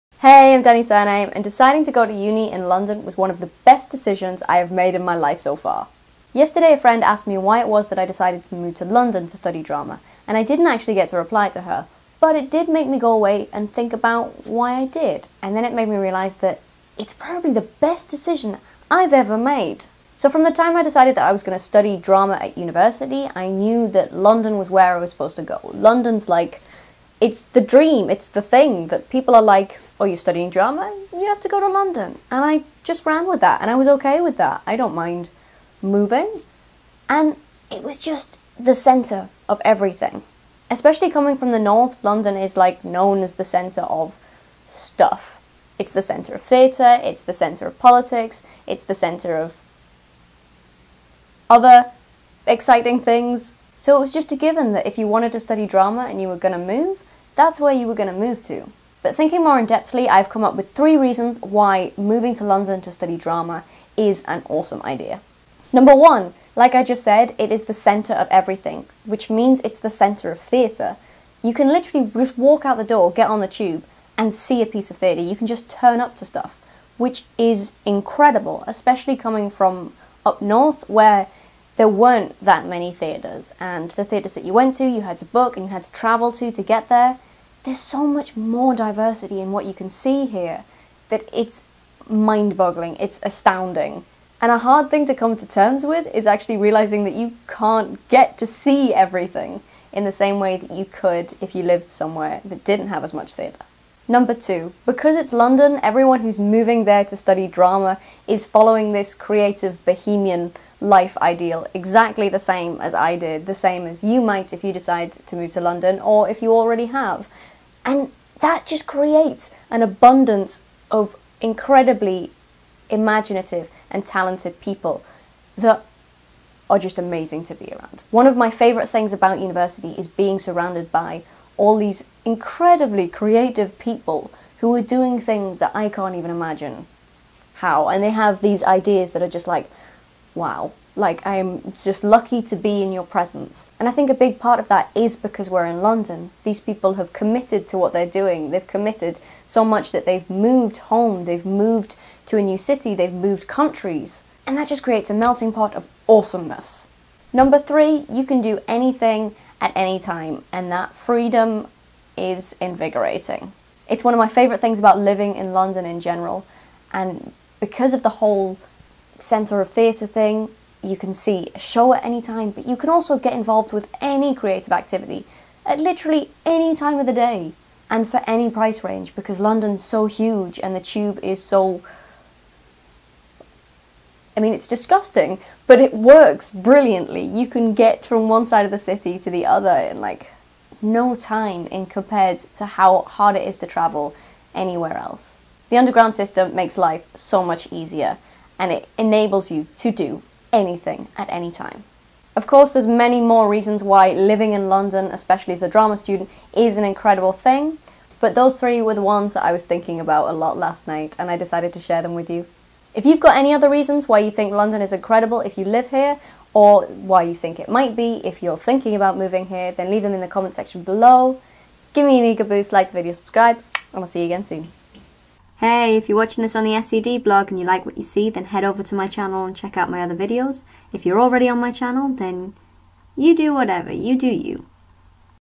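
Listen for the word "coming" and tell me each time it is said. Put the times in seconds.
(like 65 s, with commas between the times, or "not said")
41 s, 79 s.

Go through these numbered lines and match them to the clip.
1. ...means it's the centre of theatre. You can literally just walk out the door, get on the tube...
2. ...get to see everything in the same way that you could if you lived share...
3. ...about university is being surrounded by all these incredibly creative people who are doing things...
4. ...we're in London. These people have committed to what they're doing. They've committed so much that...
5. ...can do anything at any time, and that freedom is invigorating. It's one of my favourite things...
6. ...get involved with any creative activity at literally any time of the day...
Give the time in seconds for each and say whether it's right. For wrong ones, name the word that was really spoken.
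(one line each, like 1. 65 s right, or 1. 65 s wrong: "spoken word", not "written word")
1. 69 s right
2. 98 s wrong: "somewhere", not "share"
3. 129 s right
4. 145 s right
5. 158 s right
6. 173 s right.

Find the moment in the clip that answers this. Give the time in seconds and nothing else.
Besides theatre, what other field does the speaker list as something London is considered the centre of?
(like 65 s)
47 s.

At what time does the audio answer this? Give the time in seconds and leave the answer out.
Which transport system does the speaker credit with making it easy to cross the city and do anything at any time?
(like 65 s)
195 s.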